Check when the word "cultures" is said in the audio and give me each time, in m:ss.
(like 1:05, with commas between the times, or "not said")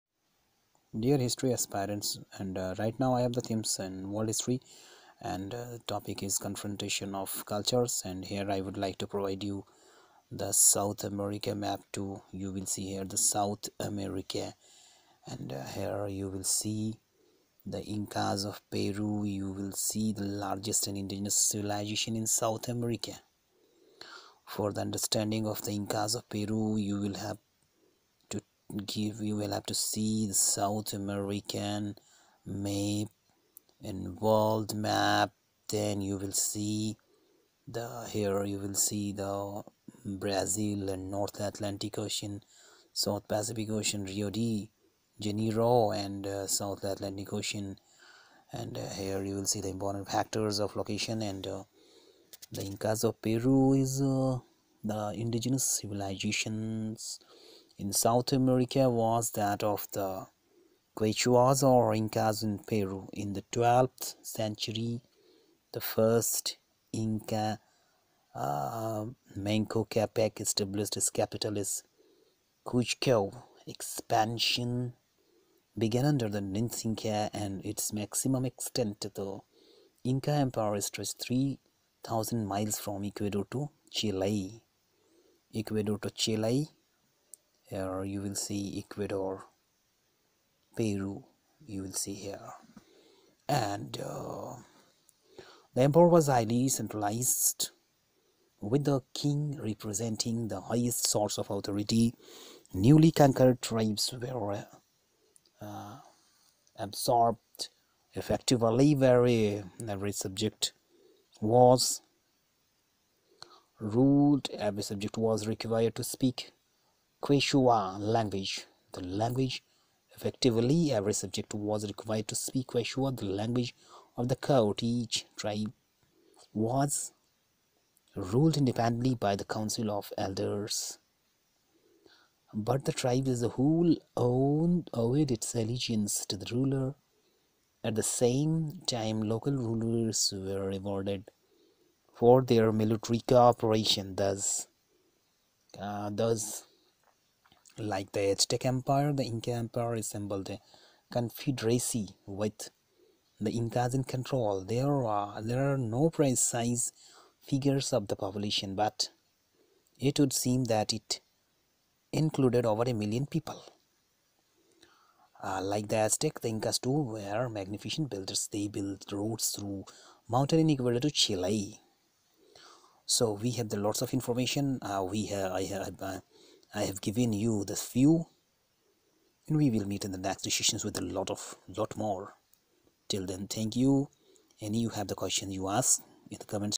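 0:07.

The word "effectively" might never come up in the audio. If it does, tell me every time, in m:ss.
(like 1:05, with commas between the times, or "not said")
1:48, 2:00.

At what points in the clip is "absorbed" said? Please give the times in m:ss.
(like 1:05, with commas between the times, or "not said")
1:46.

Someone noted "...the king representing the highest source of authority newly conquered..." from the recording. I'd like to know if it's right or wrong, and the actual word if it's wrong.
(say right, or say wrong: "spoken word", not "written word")
right.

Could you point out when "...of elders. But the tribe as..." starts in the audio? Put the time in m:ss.
2:09.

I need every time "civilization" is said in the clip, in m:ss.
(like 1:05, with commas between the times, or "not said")
0:21, 0:55.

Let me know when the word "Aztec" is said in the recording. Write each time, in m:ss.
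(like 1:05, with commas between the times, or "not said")
2:28, 2:45.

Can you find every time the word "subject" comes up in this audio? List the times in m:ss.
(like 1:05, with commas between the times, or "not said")
1:50, 1:54, 2:01.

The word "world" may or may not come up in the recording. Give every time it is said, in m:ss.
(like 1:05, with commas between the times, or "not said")
0:04, 0:34.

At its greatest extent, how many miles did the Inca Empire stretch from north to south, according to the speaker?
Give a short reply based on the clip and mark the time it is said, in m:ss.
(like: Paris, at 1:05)
3,000 miles, at 1:21.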